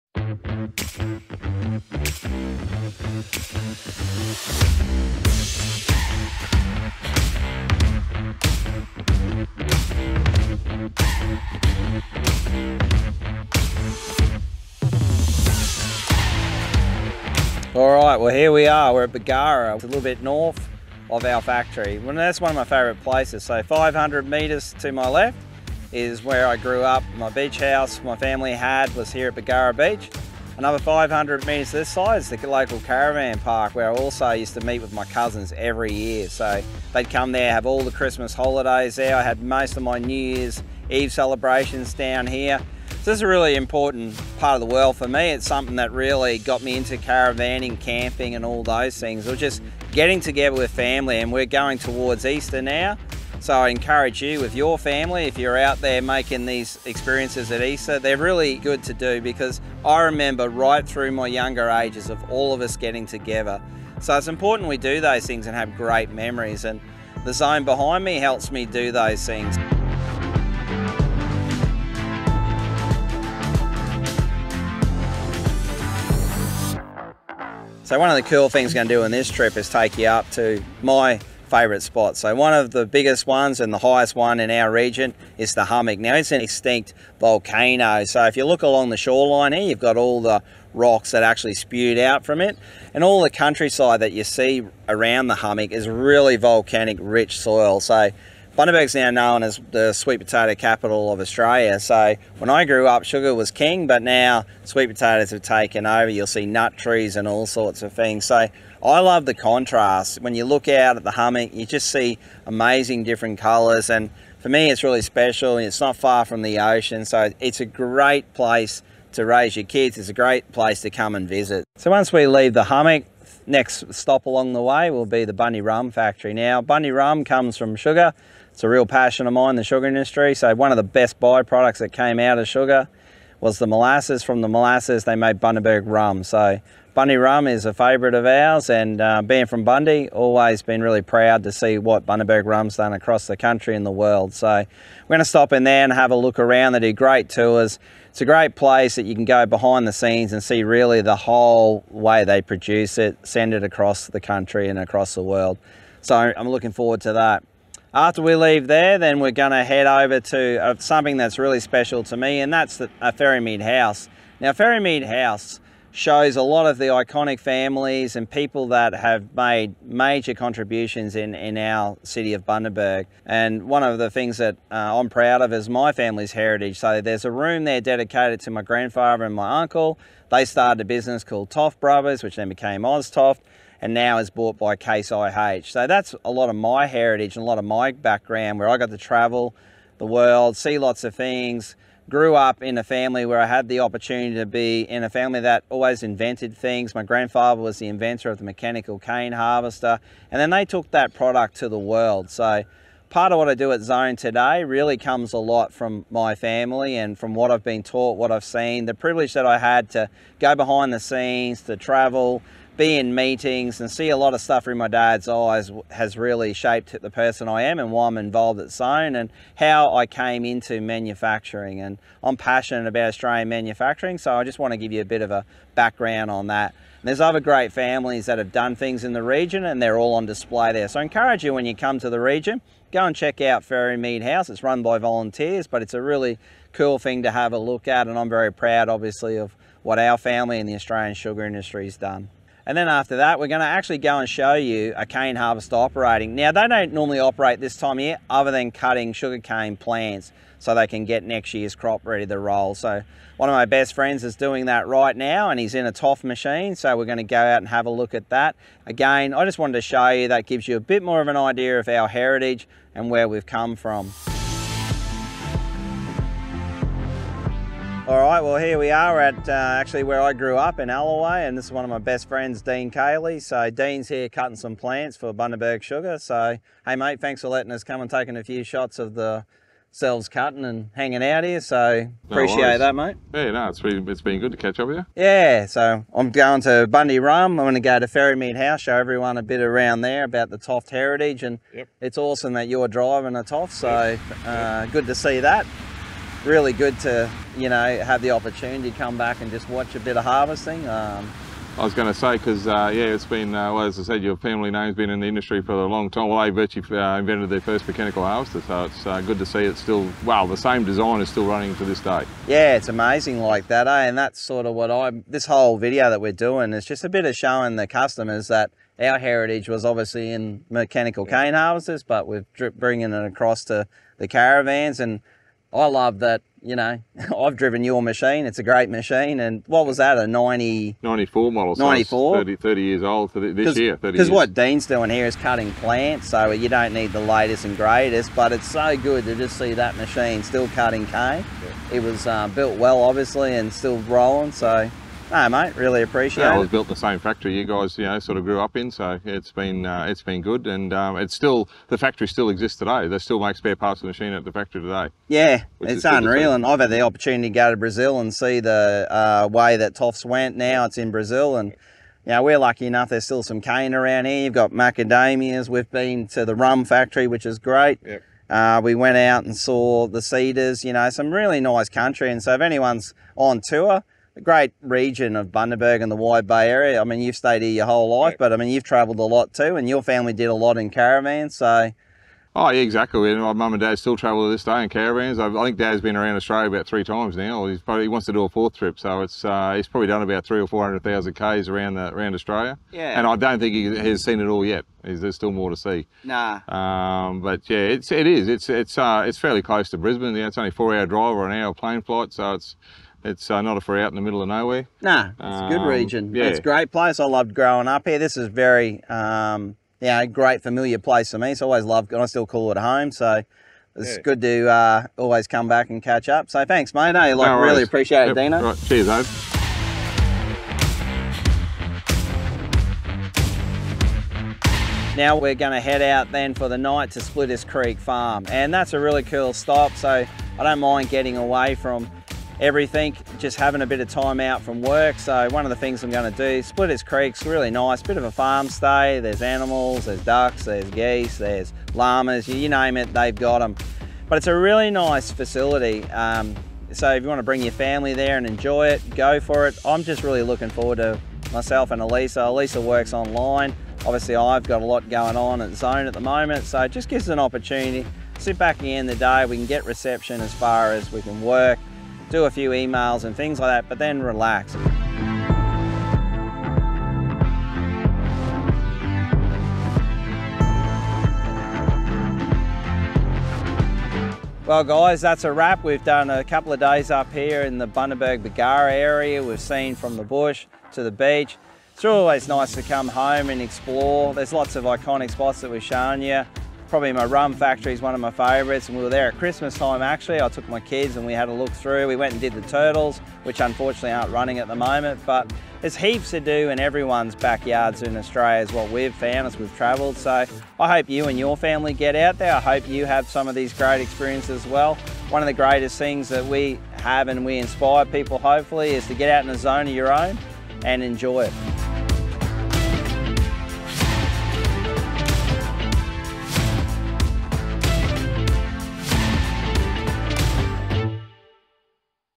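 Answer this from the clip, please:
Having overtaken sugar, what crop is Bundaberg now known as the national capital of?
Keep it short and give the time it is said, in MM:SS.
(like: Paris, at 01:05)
Sweet potatoes, at 01:39.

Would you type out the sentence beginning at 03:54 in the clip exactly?
It's run by volunteers, but it's a really cool thing to have a look at.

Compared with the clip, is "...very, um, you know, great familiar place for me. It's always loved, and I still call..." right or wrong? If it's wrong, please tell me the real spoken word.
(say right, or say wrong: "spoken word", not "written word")
right.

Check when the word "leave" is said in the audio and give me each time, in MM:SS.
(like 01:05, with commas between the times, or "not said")
02:02, 02:38.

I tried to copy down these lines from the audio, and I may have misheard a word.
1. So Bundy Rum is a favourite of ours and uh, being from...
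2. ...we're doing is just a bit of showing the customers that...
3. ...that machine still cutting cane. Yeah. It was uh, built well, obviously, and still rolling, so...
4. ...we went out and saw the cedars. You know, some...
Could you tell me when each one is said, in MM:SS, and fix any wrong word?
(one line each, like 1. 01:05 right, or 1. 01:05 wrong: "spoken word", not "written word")
1. 02:16 right
2. 05:16 right
3. 05:39 right
4. 06:08 right.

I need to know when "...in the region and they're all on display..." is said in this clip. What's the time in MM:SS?
03:49.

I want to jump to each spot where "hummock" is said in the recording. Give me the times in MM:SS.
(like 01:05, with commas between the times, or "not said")
01:25, 01:35, 01:51, 02:02.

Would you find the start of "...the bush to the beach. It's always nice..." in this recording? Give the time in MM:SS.
08:00.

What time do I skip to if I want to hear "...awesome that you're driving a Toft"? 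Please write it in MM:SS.
04:52.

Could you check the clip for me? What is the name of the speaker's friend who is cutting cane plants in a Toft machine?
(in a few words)
Dean Cayley.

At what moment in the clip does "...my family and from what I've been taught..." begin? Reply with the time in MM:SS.
03:26.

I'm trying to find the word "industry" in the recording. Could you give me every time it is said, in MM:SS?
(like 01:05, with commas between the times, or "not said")
02:09, 04:01, 05:05.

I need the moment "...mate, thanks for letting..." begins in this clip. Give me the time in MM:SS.
04:36.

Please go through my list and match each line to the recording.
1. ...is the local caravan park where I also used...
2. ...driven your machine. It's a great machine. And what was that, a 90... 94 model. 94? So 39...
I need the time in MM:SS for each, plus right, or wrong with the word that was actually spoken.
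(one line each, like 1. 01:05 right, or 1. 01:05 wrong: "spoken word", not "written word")
1. 00:32 right
2. 05:27 wrong: "30", not "39".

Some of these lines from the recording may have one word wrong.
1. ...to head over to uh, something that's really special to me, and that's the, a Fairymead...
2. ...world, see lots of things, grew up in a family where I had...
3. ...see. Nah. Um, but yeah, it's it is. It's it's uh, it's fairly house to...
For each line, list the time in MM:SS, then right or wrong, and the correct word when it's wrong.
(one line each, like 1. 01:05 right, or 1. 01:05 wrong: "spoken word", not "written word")
1. 02:39 right
2. 03:10 right
3. 06:35 wrong: "close", not "house".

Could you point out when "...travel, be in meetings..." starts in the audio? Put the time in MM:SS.
03:31.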